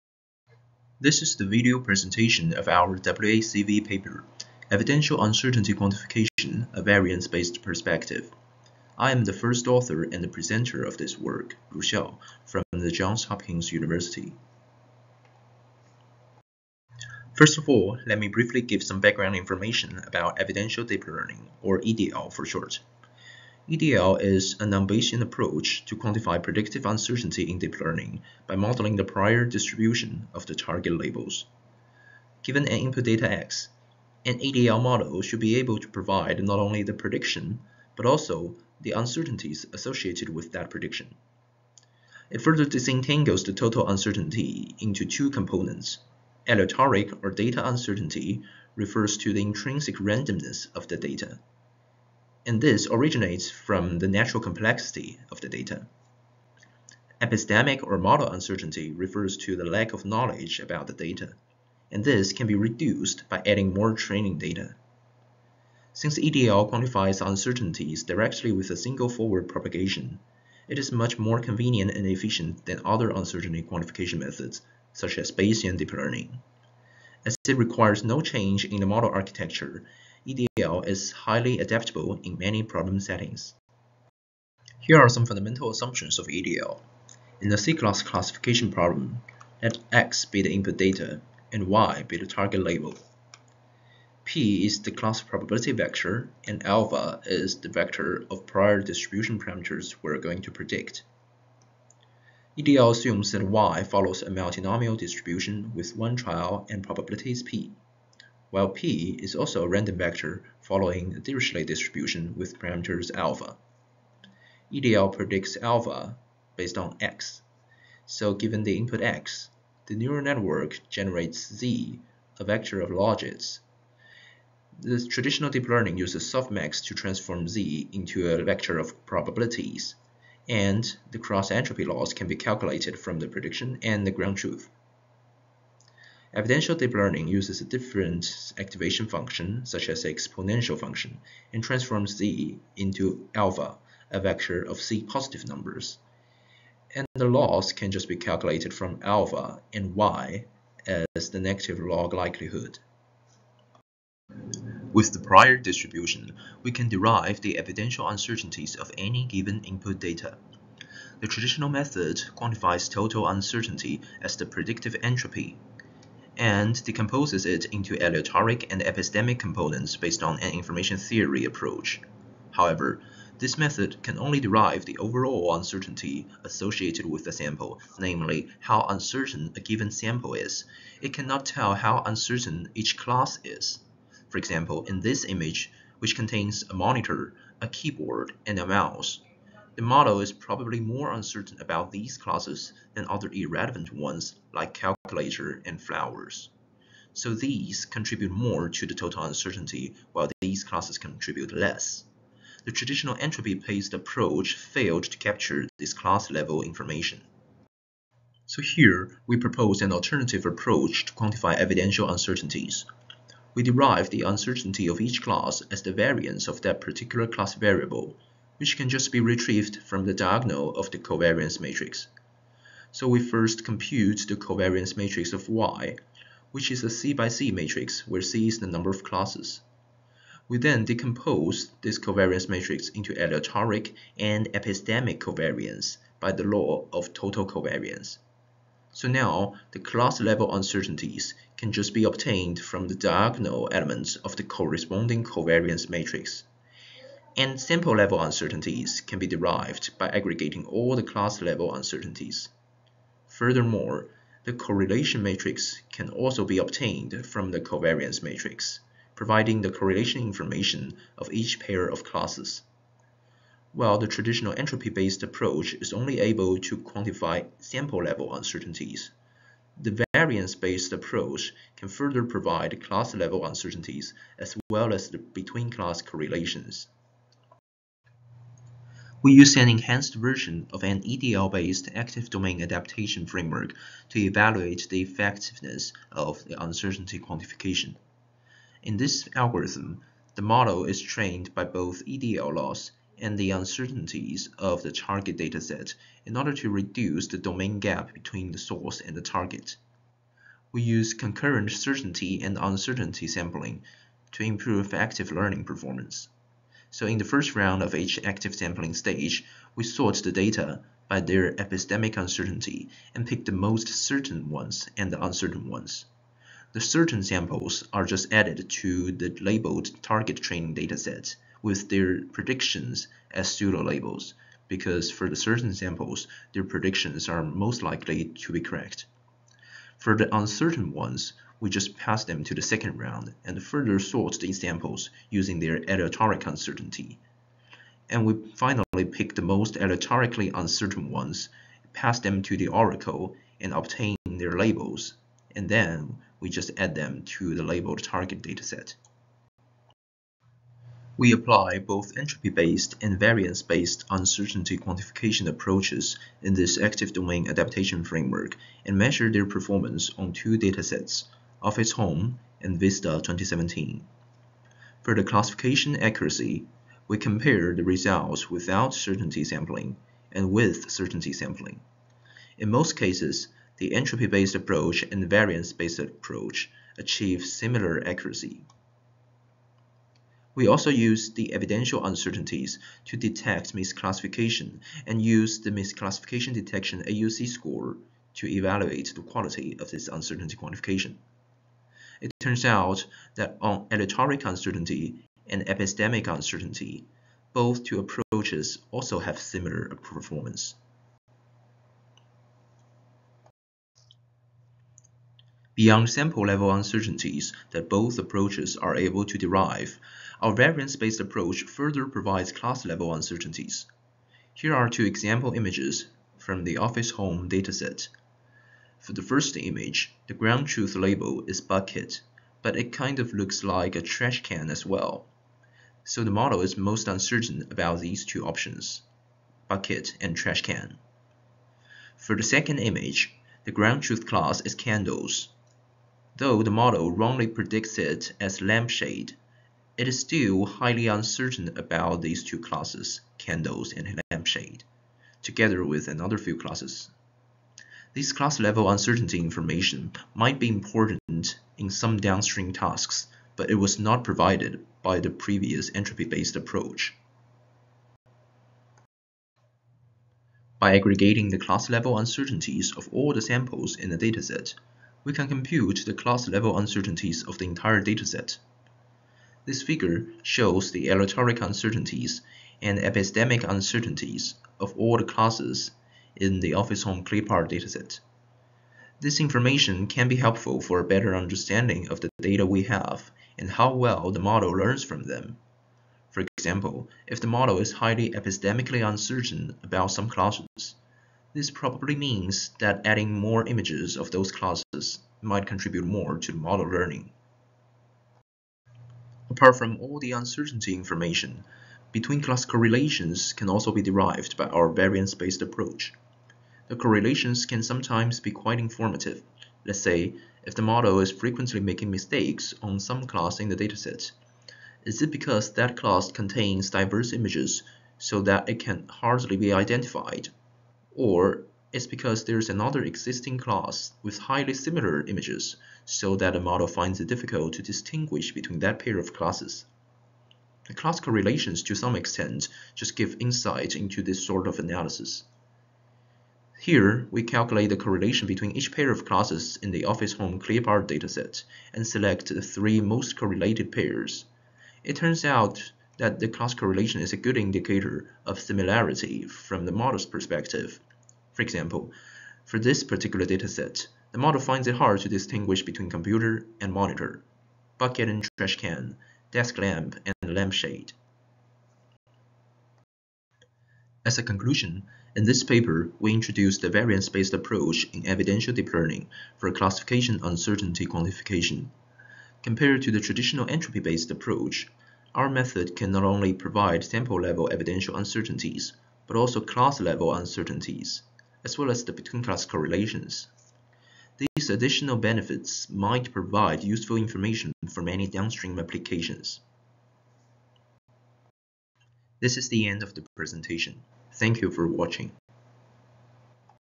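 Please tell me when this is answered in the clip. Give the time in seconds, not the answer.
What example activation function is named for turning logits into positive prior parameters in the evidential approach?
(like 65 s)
140 s.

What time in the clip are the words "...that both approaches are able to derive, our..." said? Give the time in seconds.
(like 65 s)
407 s.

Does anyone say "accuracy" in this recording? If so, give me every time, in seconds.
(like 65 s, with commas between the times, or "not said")
365 s, 378 s.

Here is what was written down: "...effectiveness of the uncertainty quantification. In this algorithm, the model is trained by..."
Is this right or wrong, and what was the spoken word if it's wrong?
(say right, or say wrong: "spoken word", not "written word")
right.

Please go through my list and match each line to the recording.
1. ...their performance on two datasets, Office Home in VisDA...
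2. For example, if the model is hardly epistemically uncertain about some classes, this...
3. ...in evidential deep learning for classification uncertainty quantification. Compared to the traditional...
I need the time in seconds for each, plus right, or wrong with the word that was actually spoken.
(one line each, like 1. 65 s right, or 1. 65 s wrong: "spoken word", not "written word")
1. 359 s right
2. 486 s wrong: "highly", not "hardly"
3. 568 s right.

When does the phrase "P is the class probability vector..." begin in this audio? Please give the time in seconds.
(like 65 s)
94 s.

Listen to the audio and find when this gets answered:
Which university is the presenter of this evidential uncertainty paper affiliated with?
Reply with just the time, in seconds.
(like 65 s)
12 s.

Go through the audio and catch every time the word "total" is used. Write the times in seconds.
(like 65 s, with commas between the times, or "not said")
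43 s, 162 s, 198 s, 237 s.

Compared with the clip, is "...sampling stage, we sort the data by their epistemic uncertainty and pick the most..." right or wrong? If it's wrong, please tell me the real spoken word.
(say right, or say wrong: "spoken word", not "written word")
right.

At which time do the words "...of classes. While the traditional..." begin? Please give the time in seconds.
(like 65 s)
261 s.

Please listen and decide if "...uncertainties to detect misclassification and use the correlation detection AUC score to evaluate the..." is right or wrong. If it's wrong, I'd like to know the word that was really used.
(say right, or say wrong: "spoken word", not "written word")
wrong: "misclassification", not "correlation".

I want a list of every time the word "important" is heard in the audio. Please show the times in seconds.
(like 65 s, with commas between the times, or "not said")
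450 s.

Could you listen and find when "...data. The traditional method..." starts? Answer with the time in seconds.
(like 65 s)
159 s.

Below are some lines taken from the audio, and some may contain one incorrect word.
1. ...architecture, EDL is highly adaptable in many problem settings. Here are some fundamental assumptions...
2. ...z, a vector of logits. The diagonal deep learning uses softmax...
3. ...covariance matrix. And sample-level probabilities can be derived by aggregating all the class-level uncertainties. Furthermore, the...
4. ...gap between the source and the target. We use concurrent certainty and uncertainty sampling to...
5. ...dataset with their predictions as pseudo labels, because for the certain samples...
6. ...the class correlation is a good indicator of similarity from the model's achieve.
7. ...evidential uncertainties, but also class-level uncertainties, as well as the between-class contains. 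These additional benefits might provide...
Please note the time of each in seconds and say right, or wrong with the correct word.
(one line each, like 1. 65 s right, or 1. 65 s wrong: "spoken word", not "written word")
1. 79 s right
2. 121 s wrong: "traditional", not "diagonal"
3. 245 s wrong: "uncertainties", not "probabilities"
4. 297 s right
5. 320 s right
6. 546 s wrong: "perspective", not "achieve"
7. 577 s wrong: "correlations", not "contains".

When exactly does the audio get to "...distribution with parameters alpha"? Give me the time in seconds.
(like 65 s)
111 s.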